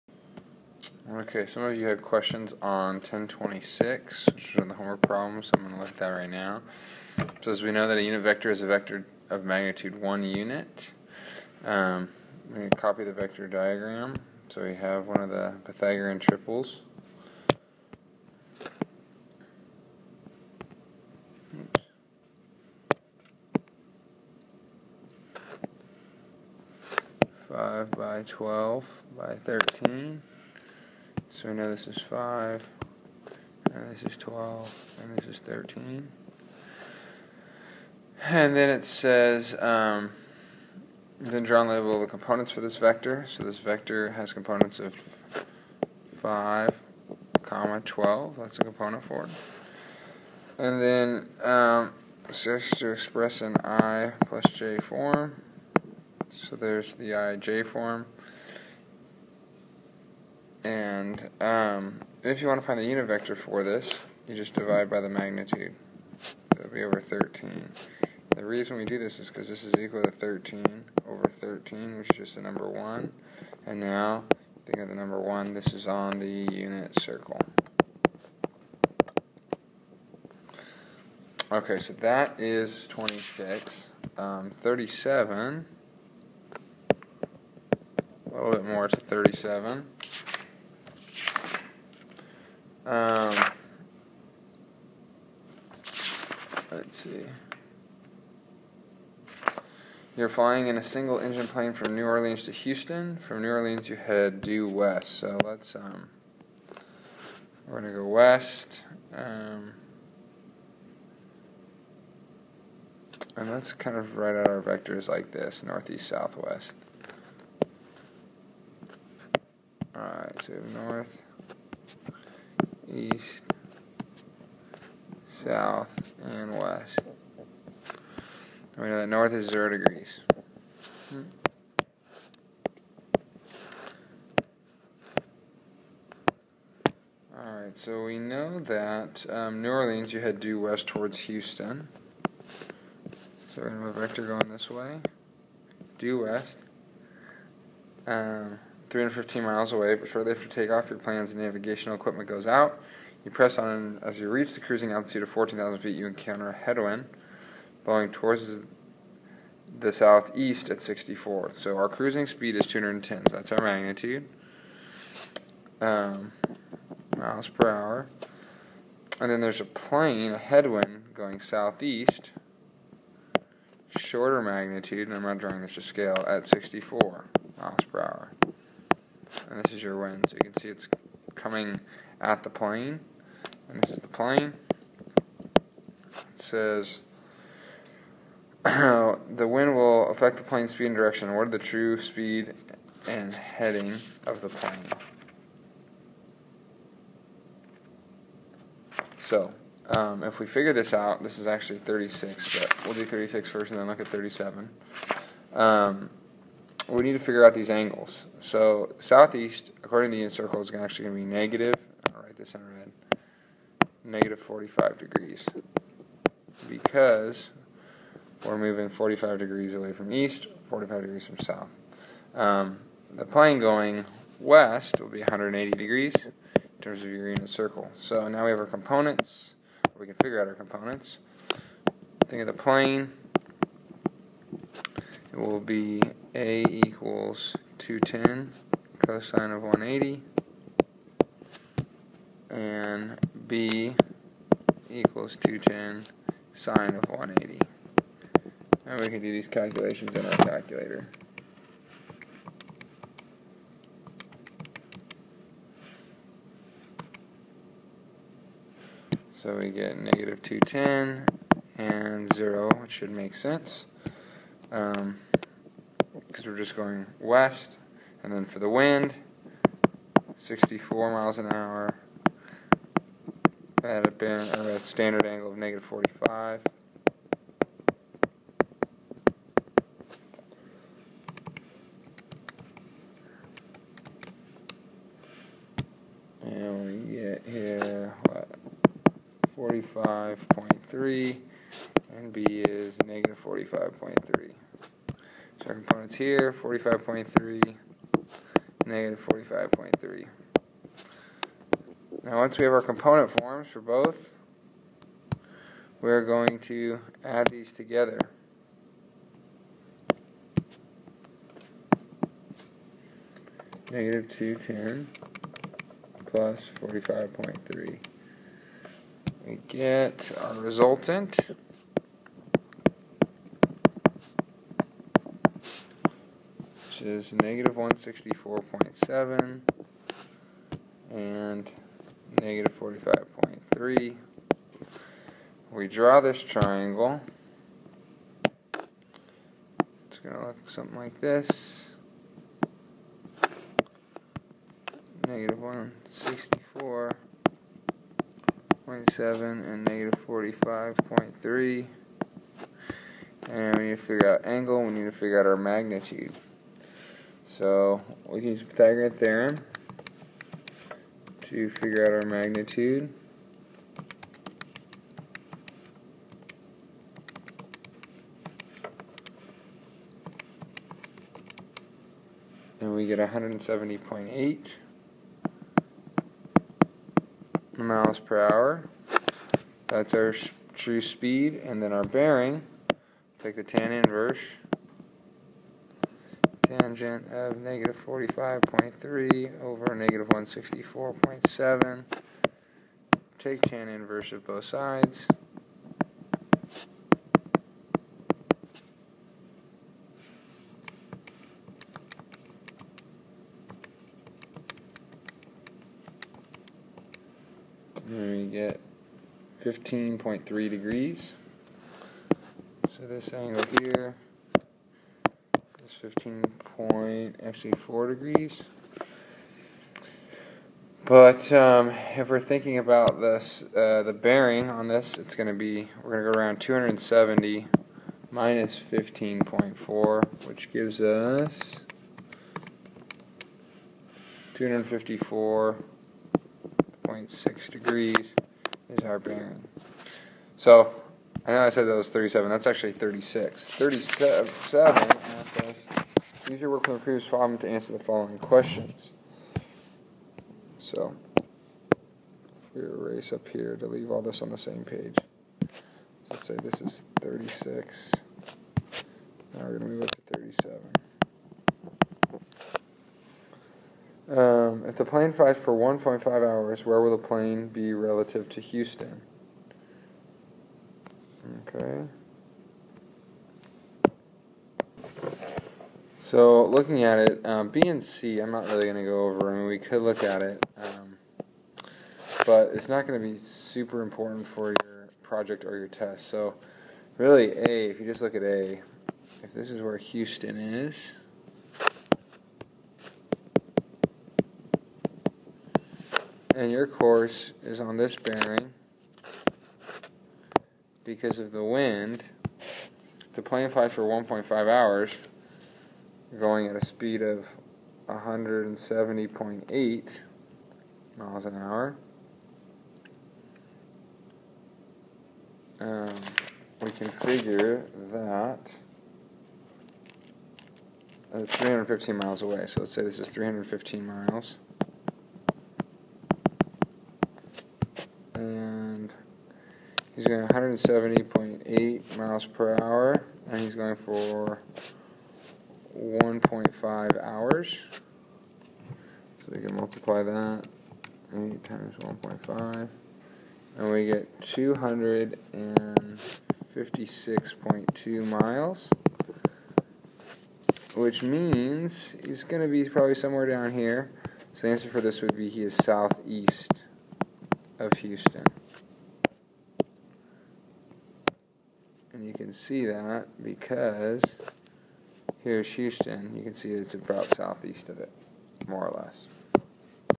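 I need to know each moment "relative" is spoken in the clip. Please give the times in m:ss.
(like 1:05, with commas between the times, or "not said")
7:47.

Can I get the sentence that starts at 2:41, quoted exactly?
So our cruising speed is 210.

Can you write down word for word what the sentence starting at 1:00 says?
And um, if you want to find the unit vector for this, you just divide by the magnitude.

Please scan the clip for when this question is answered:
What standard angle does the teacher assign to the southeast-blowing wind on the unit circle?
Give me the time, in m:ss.
3:34.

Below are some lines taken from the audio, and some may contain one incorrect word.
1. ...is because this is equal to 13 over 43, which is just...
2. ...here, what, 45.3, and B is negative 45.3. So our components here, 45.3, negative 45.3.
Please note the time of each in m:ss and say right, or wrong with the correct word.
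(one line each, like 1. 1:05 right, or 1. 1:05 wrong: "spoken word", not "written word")
1. 1:09 wrong: "13", not "43"
2. 4:47 right.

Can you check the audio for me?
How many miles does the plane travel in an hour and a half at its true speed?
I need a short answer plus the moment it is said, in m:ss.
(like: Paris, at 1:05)
256.2 miles, at 9:04.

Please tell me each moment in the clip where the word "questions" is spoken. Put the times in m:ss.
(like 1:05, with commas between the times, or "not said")
0:02, 7:28.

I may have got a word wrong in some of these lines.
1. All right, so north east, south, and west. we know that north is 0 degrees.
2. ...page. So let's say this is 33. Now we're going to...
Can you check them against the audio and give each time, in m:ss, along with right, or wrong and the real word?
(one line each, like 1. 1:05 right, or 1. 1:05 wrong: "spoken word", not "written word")
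1. 1:59 right
2. 7:34 wrong: "36", not "33".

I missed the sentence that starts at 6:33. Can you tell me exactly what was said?
Take tan inverse of both sides.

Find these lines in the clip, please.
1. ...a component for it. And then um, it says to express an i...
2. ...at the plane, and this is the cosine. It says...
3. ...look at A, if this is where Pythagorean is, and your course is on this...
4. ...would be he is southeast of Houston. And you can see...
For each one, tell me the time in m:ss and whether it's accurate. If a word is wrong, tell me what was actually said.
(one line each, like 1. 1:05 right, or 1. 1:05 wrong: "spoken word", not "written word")
1. 0:48 right
2. 3:02 wrong: "plane", not "cosine"
3. 8:08 wrong: "Houston", not "Pythagorean"
4. 9:15 right.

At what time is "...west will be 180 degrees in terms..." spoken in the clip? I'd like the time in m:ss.
3:44.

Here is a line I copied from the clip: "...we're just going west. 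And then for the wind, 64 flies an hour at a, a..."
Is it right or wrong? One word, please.
wrong.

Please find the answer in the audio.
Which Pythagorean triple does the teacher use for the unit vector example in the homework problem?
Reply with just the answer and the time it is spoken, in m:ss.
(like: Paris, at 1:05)
5, 12, 13, at 0:27.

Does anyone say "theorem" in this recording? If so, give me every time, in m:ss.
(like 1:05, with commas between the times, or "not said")
5:59.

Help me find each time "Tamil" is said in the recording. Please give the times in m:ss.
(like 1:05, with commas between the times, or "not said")
not said.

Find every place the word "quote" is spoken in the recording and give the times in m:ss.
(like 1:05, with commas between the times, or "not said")
not said.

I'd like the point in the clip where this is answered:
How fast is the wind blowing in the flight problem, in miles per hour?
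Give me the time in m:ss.
2:56.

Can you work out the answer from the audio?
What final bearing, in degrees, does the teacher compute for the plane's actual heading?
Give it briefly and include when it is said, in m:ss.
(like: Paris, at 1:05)
254.6 degrees, at 7:14.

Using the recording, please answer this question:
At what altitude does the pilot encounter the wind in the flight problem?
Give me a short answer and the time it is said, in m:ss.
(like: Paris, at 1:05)
14,000 feet, at 2:35.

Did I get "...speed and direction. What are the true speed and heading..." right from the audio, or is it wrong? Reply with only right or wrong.
right.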